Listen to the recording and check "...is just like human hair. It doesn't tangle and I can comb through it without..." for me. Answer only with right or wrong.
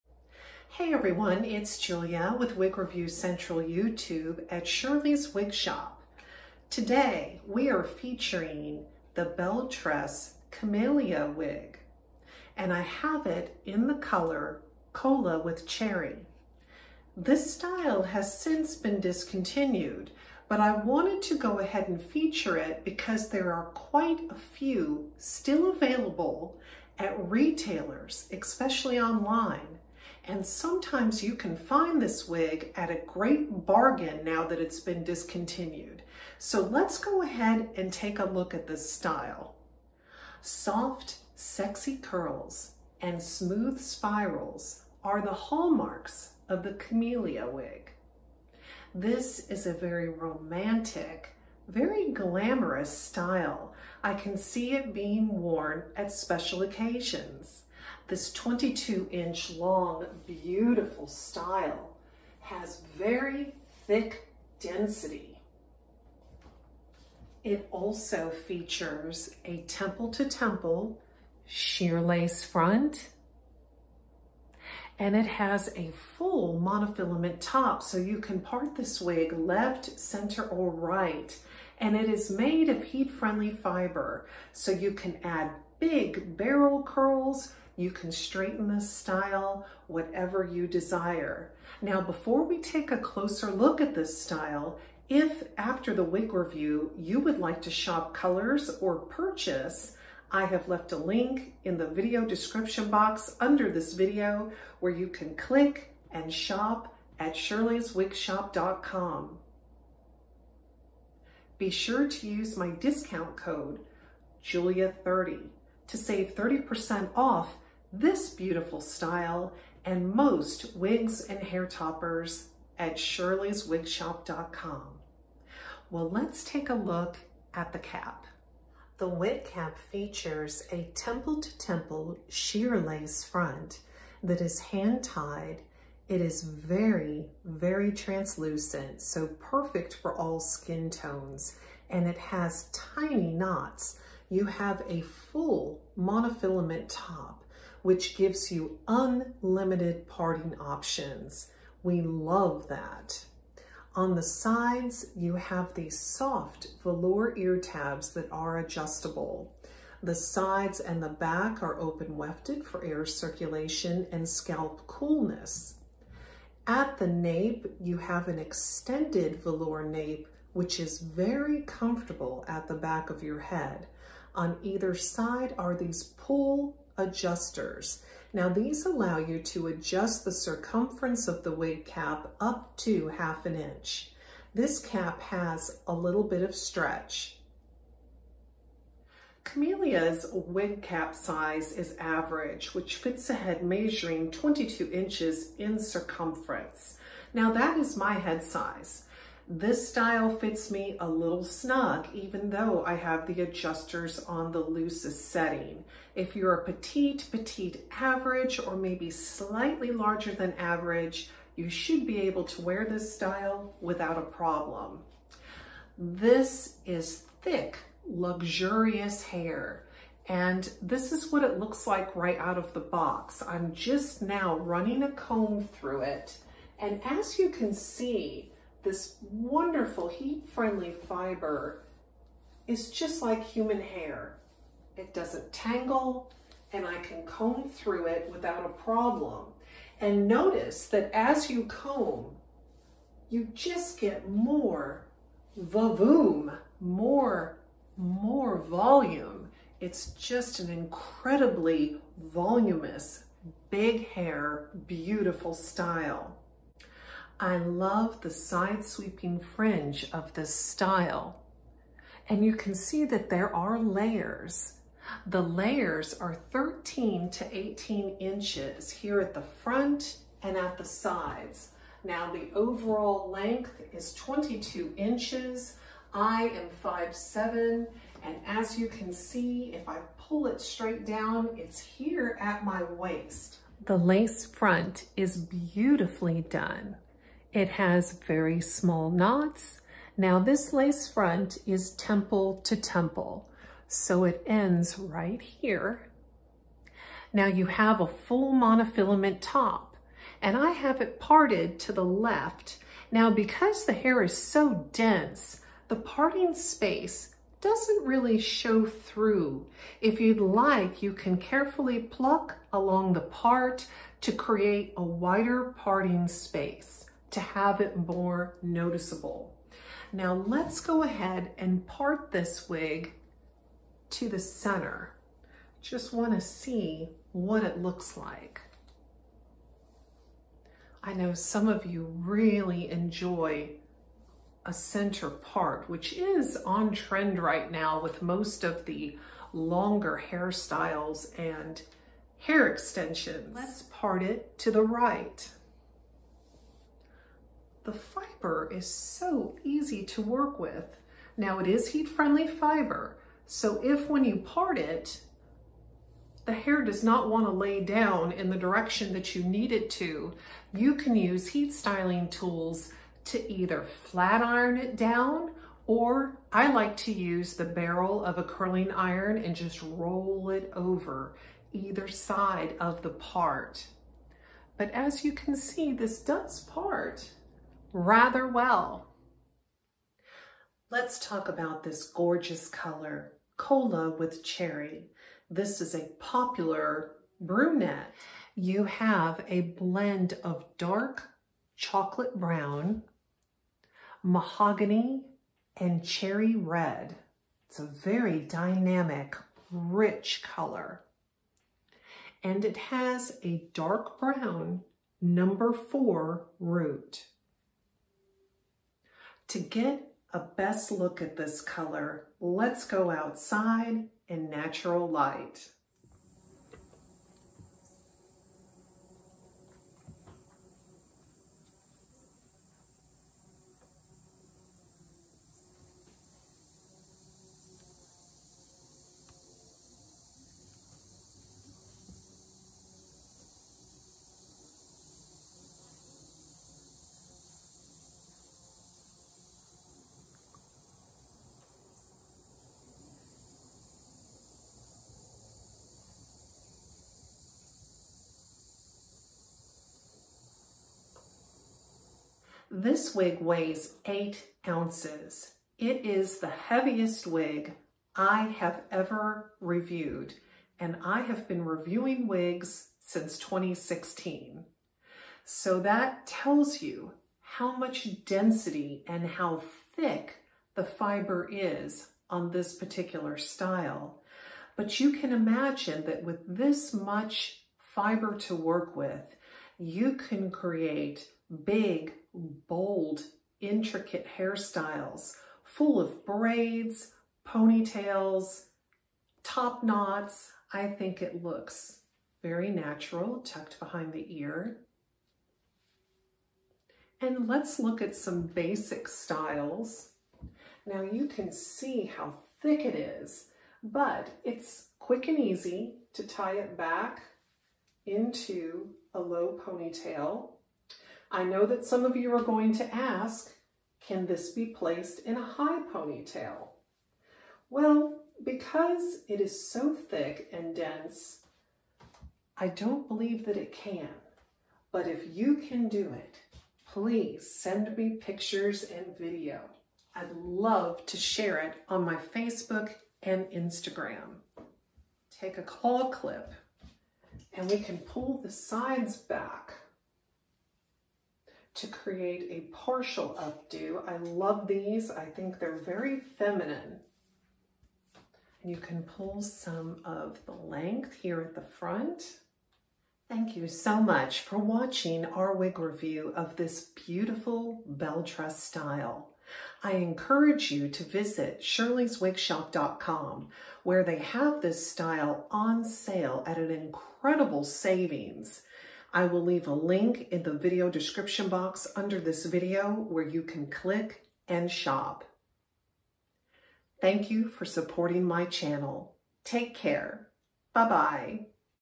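right.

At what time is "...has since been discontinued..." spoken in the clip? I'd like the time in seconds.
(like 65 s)
18 s.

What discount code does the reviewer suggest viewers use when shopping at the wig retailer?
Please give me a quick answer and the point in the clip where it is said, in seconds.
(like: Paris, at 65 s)
Julia30, at 114 s.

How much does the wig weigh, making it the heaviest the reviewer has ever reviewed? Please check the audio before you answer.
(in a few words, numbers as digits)
8 ounces.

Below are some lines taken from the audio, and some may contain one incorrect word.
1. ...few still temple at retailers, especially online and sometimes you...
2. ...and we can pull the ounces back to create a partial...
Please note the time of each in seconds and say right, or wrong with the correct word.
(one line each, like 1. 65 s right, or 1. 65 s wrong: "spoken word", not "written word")
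1. 24 s wrong: "available", not "temple"
2. 537 s wrong: "sides", not "ounces".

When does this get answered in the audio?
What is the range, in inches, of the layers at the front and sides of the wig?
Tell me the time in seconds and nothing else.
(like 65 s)
266 s.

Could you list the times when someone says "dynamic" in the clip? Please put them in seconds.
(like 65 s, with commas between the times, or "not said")
398 s.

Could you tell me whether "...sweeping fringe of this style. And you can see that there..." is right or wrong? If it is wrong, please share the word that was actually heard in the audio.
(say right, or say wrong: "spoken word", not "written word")
right.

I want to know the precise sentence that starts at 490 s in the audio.
I think it looks very natural, tucked behind the ear.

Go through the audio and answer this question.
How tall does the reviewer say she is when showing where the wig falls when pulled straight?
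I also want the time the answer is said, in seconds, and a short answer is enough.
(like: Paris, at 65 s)
5'7", at 276 s.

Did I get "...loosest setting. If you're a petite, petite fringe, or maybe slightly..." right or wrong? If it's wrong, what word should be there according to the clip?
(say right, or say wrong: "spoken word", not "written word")
wrong: "average", not "fringe".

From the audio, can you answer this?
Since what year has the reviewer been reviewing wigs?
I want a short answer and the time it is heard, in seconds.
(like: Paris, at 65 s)
2016, at 463 s.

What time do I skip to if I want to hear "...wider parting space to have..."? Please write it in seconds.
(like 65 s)
315 s.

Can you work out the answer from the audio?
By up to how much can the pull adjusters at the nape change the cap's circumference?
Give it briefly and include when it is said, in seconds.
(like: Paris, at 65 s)
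half an inch, at 183 s.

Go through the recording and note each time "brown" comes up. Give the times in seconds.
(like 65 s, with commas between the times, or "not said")
392 s, 404 s.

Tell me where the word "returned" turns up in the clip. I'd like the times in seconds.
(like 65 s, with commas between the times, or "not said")
not said.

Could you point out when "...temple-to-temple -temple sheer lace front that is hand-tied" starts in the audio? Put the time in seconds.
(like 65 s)
130 s.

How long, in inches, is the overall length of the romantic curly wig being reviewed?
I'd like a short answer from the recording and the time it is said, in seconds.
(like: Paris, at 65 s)
22 inches, at 58 s.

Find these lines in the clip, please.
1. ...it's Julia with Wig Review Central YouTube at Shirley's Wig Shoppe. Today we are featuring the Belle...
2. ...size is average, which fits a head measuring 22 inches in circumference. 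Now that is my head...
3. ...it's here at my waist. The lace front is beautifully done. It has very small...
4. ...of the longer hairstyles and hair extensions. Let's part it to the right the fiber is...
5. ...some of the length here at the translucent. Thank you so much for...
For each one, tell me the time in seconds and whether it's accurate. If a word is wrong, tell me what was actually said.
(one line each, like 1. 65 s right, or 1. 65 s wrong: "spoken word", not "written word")
1. 1 s right
2. 191 s right
3. 281 s right
4. 338 s right
5. 549 s wrong: "front", not "translucent".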